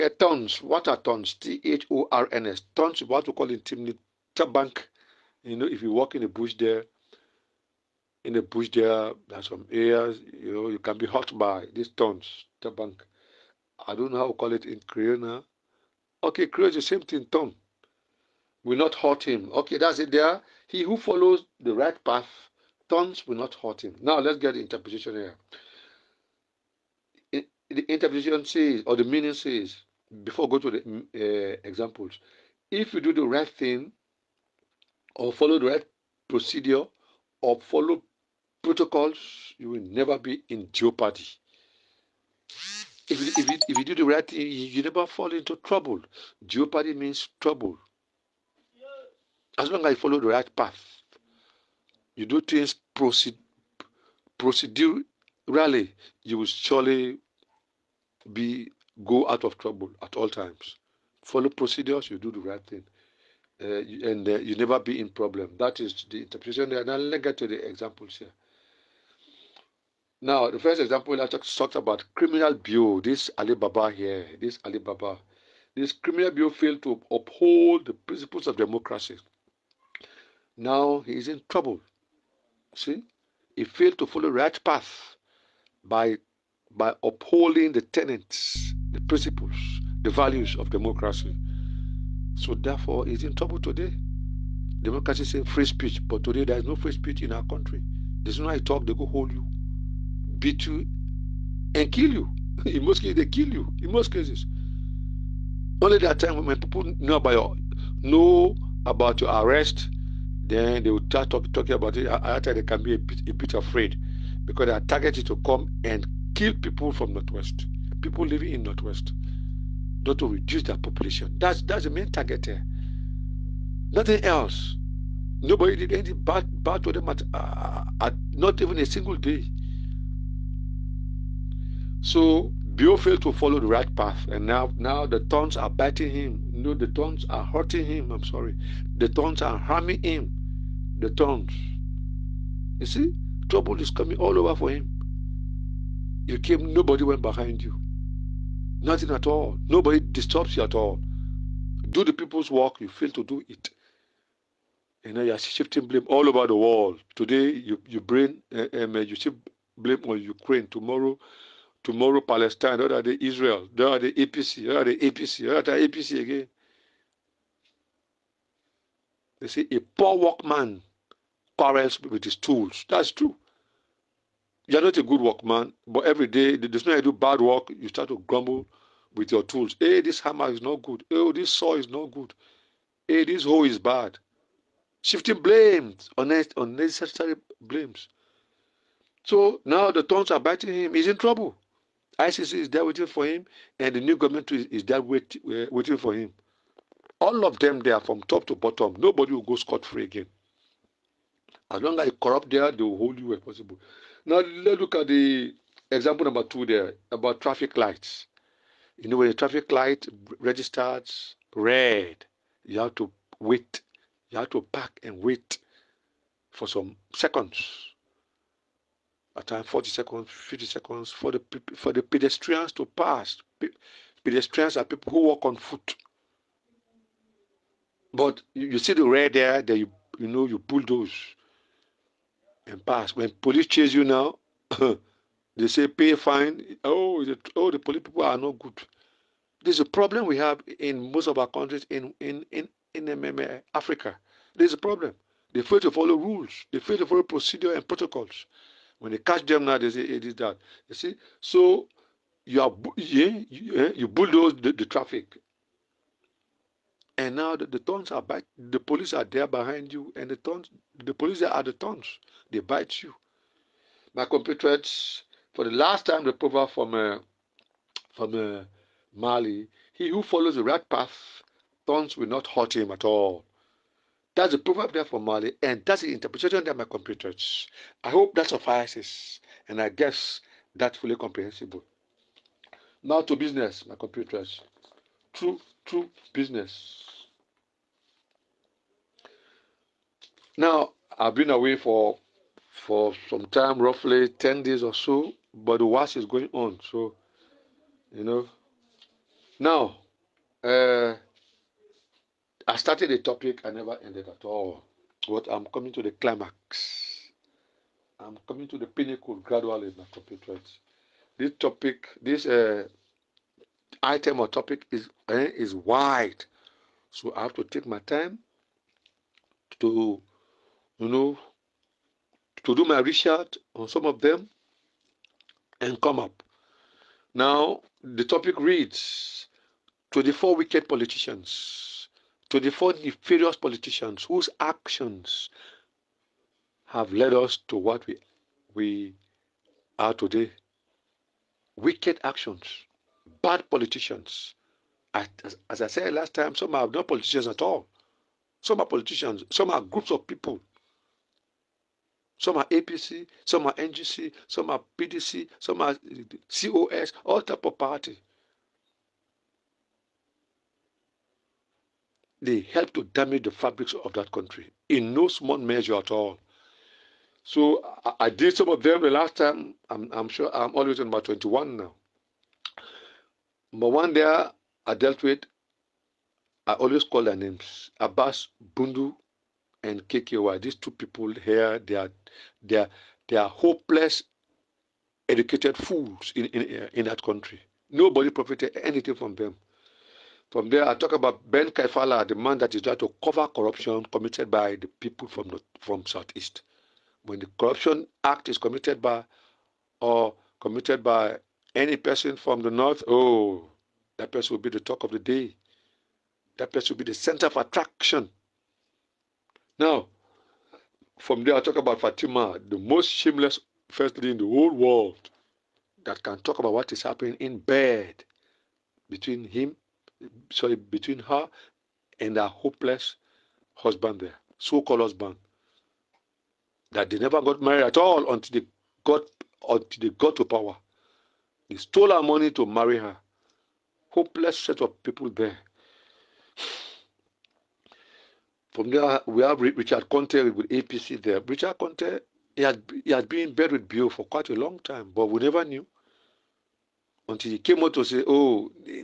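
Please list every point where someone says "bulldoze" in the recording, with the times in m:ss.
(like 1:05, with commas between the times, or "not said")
3:50, 4:14.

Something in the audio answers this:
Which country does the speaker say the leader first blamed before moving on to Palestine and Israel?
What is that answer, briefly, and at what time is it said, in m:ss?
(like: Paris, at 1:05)
Ukraine, at 2:40.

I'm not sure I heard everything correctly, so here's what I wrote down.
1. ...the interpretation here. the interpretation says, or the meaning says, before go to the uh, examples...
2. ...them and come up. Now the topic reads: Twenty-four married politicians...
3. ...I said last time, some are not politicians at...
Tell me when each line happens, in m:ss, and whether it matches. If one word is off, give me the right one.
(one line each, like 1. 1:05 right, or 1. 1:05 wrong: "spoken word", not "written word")
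1. 0:24 right
2. 5:24 wrong: "wicked", not "married"
3. 5:45 right.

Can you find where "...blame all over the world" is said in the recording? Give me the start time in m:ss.
2:35.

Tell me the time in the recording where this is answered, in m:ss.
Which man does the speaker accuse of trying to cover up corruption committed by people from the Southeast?
6:31.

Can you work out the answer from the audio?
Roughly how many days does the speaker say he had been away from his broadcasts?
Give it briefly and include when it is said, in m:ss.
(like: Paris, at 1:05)
10, at 4:54.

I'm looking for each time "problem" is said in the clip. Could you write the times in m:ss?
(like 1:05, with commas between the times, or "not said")
1:05, 3:59, 4:04.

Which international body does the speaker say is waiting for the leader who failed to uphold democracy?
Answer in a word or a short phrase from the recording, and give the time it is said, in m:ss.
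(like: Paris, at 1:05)
ICC, at 3:12.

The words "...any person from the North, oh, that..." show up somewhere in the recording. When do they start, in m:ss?
6:41.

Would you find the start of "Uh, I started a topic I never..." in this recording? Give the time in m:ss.
5:00.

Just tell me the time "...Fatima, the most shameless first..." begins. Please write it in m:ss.
6:51.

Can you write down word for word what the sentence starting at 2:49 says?
They say a poor workman quarrels with his tools.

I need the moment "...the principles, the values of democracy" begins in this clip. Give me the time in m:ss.
1:28.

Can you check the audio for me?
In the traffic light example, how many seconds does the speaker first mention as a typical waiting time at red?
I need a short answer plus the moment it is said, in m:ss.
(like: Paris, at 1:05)
40 seconds, at 3:39.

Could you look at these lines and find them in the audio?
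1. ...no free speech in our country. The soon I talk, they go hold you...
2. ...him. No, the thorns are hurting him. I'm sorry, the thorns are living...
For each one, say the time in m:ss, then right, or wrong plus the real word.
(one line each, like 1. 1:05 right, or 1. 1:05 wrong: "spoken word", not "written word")
1. 1:36 right
2. 2:16 wrong: "harming", not "living".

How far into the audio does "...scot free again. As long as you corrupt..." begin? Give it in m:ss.
3:19.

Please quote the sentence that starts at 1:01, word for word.
Follow procedures, you do the right thing.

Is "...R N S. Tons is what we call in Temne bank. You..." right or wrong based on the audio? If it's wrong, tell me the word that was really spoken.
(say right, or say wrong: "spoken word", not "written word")
right.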